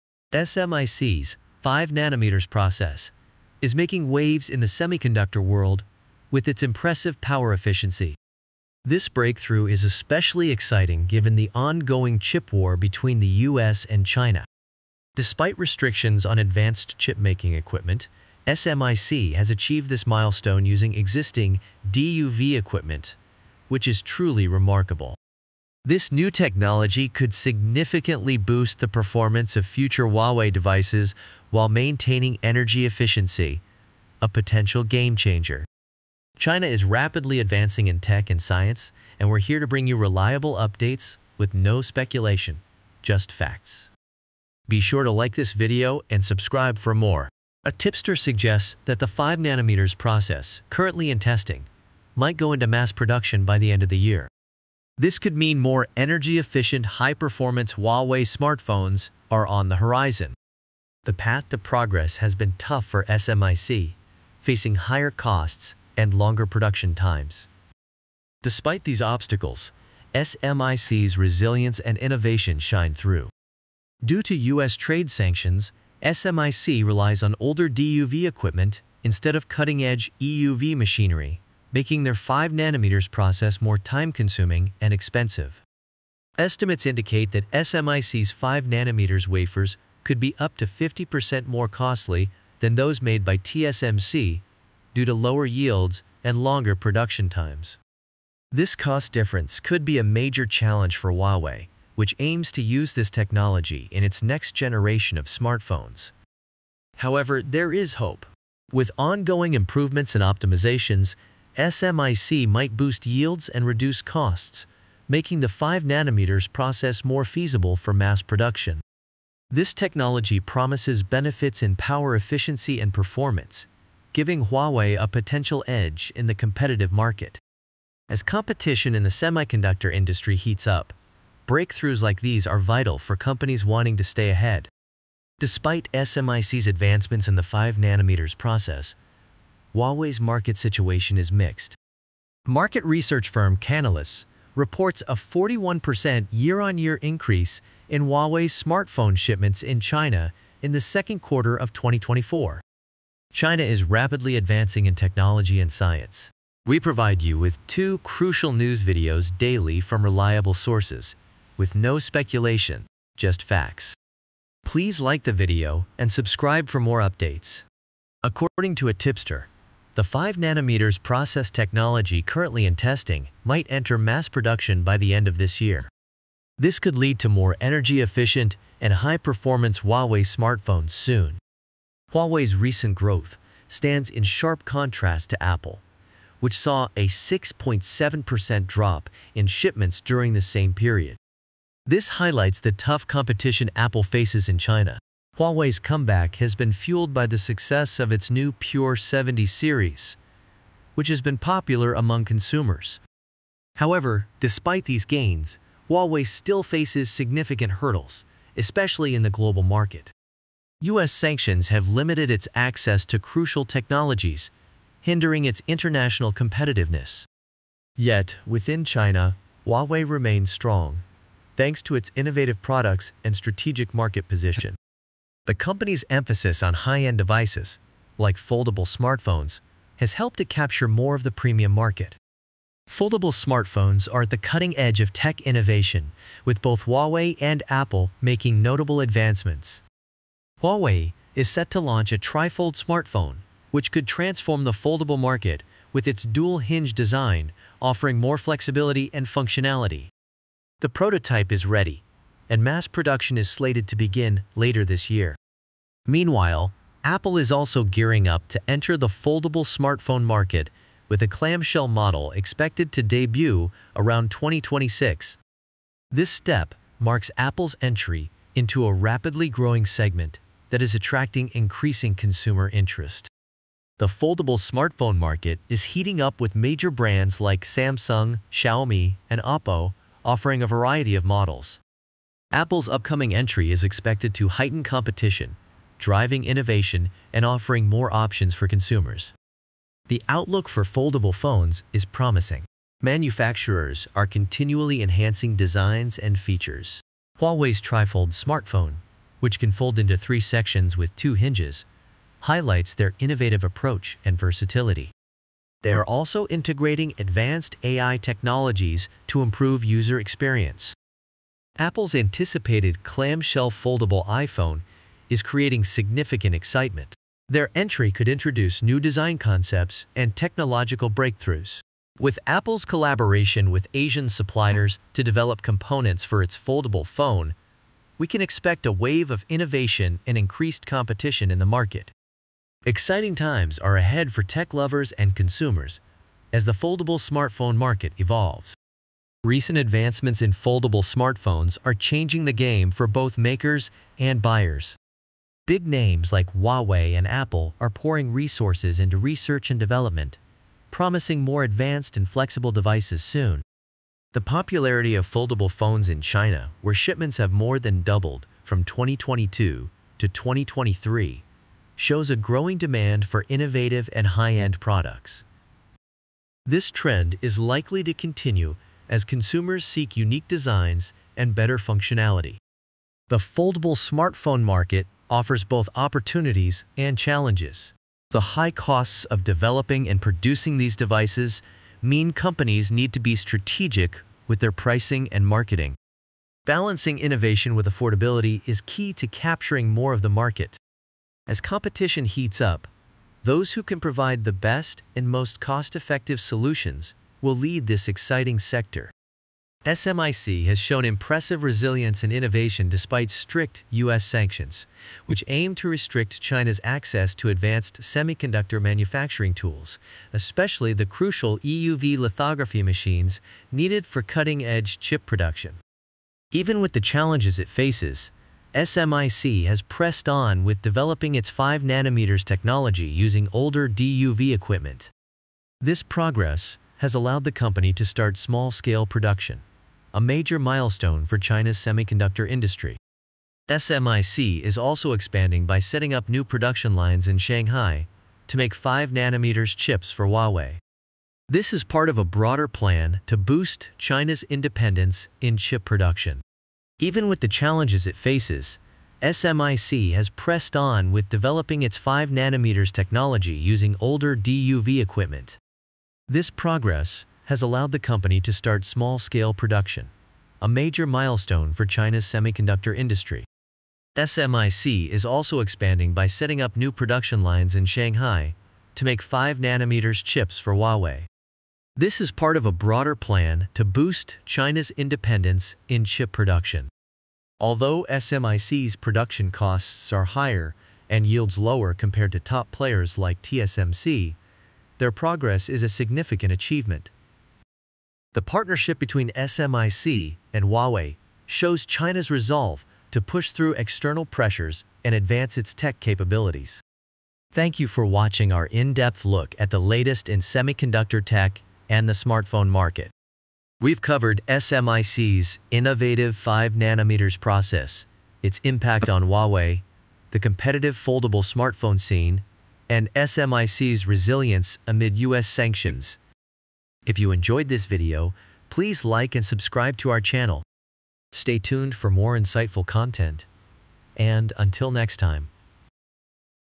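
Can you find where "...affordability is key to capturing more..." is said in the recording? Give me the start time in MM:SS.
06:27.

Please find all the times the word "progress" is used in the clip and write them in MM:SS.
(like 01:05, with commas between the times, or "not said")
01:01, 07:06, 07:36, 08:05.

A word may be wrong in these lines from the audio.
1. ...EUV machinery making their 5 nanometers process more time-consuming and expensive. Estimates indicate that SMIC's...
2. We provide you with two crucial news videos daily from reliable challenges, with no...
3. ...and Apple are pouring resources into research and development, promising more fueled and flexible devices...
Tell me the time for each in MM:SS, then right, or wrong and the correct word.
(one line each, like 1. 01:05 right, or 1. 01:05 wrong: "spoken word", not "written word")
1. 01:20 right
2. 02:36 wrong: "sources", not "challenges"
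3. 05:47 wrong: "advanced", not "fueled".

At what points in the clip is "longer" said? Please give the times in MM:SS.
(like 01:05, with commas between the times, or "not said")
01:06, 01:36.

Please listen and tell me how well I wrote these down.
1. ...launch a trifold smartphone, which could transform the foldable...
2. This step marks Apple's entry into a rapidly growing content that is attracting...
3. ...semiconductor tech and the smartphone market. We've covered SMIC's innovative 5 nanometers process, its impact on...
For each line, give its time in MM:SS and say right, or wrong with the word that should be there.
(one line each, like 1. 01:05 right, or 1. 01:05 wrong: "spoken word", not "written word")
1. 04:01 right
2. 04:26 wrong: "segment", not "content"
3. 08:20 right.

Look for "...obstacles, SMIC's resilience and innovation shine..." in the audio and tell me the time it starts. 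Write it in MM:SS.
01:09.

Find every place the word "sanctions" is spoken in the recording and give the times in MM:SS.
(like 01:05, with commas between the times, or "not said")
01:15, 03:31, 06:44, 08:35.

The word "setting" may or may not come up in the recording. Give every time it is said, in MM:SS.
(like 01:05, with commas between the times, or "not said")
07:15, 07:46.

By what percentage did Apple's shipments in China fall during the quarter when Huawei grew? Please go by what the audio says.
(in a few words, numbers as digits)
6.7%.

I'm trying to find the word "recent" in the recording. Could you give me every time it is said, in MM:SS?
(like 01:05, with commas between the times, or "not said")
03:02, 05:39.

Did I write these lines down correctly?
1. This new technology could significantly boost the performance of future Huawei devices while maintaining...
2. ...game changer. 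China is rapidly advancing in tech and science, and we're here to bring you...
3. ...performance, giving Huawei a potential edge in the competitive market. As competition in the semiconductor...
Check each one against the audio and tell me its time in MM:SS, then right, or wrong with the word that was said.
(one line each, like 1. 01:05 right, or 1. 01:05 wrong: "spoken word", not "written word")
1. 00:25 right
2. 00:34 right
3. 02:02 right.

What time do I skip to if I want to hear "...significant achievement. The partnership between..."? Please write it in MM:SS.
08:05.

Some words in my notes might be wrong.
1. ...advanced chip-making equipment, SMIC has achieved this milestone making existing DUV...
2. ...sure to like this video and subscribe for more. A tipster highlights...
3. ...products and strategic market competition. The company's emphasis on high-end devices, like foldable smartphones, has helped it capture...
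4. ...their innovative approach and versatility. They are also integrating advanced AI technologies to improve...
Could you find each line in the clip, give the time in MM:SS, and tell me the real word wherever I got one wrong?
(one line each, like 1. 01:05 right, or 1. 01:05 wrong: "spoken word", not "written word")
1. 00:16 wrong: "using", not "making"
2. 00:44 wrong: "suggests", not "highlights"
3. 03:42 wrong: "position", not "competition"
4. 05:02 right.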